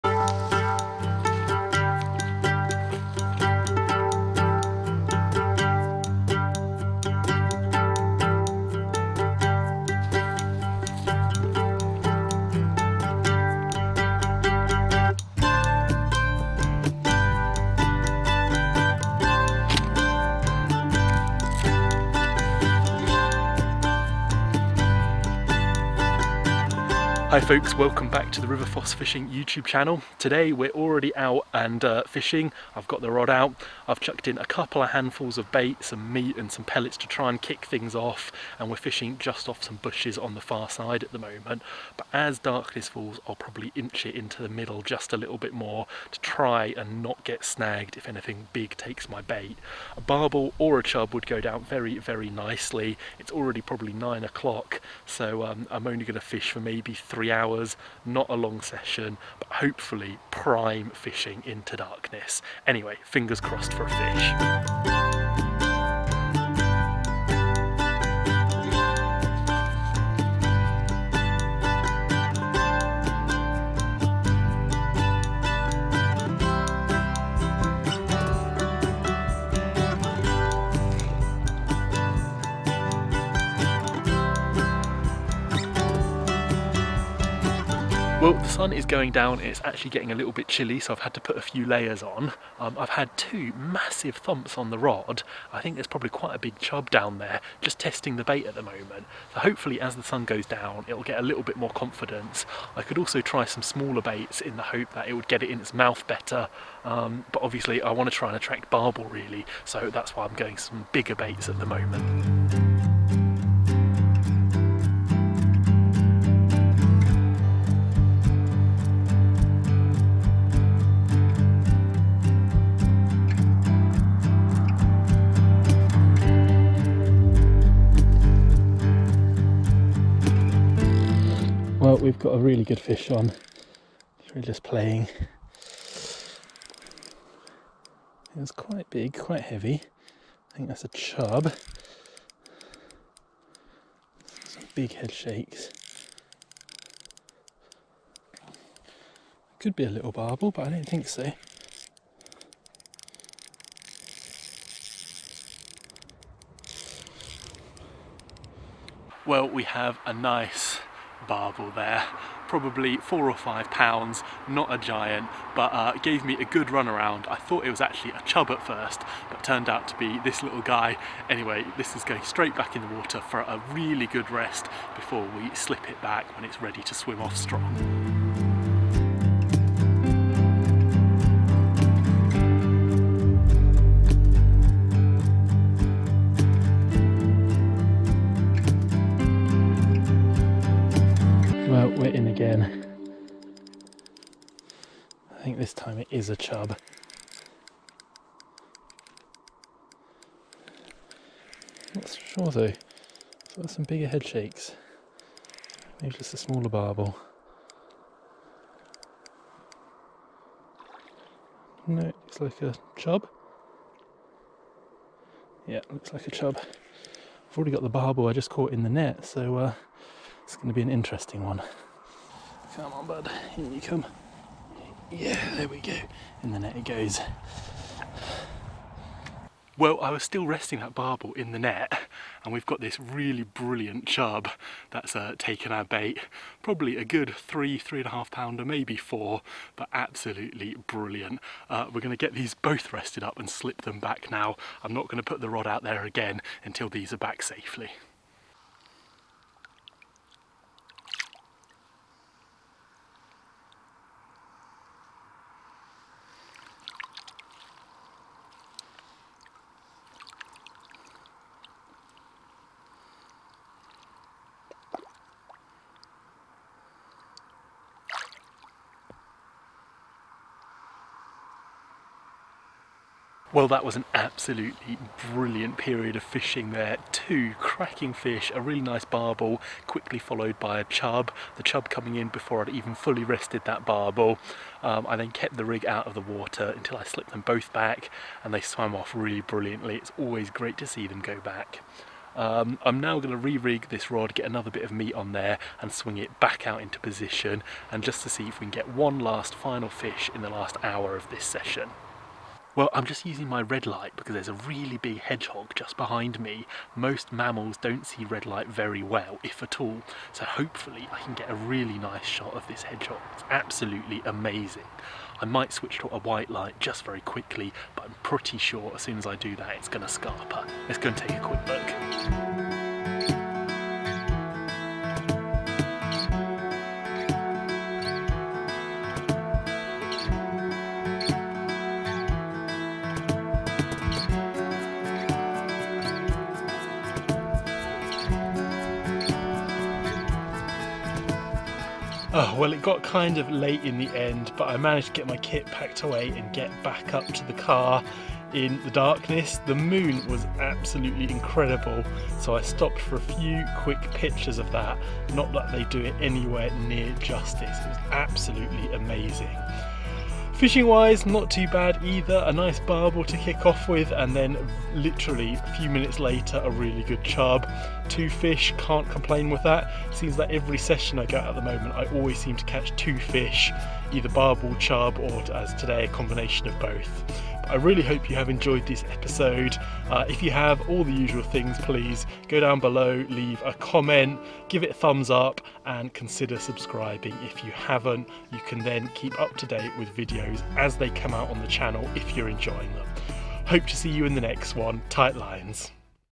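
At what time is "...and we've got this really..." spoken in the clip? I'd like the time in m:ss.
3:52.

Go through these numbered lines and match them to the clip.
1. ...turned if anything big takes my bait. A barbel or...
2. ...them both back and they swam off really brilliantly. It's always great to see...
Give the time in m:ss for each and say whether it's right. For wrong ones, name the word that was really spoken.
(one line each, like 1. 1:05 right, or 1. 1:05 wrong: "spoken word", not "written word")
1. 0:47 wrong: "snagged", not "turned"
2. 4:47 right.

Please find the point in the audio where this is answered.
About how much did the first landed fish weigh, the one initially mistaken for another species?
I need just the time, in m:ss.
2:42.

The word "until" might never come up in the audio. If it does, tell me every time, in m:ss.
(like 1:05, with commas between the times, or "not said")
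4:06, 4:46.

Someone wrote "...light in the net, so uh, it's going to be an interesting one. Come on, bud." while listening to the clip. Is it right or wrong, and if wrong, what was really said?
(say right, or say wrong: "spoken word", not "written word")
wrong: "caught", not "light".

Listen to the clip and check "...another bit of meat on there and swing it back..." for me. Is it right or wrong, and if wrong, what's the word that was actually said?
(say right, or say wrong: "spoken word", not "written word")
right.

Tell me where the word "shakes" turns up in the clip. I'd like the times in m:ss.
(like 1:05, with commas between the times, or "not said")
2:25, 3:24.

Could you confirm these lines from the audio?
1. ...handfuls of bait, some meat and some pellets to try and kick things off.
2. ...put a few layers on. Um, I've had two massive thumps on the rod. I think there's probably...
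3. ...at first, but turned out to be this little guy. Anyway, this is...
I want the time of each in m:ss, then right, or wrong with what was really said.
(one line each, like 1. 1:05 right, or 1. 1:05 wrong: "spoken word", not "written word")
1. 0:34 right
2. 1:31 right
3. 2:48 right.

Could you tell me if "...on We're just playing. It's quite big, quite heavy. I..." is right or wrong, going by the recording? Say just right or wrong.
right.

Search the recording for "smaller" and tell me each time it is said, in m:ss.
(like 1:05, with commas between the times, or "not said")
1:43, 3:26.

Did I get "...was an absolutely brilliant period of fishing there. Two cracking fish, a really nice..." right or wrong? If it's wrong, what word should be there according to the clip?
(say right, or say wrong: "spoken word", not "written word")
right.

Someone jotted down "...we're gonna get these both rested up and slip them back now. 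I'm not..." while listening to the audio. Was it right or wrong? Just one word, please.
right.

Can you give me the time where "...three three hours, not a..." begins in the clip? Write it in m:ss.
0:56.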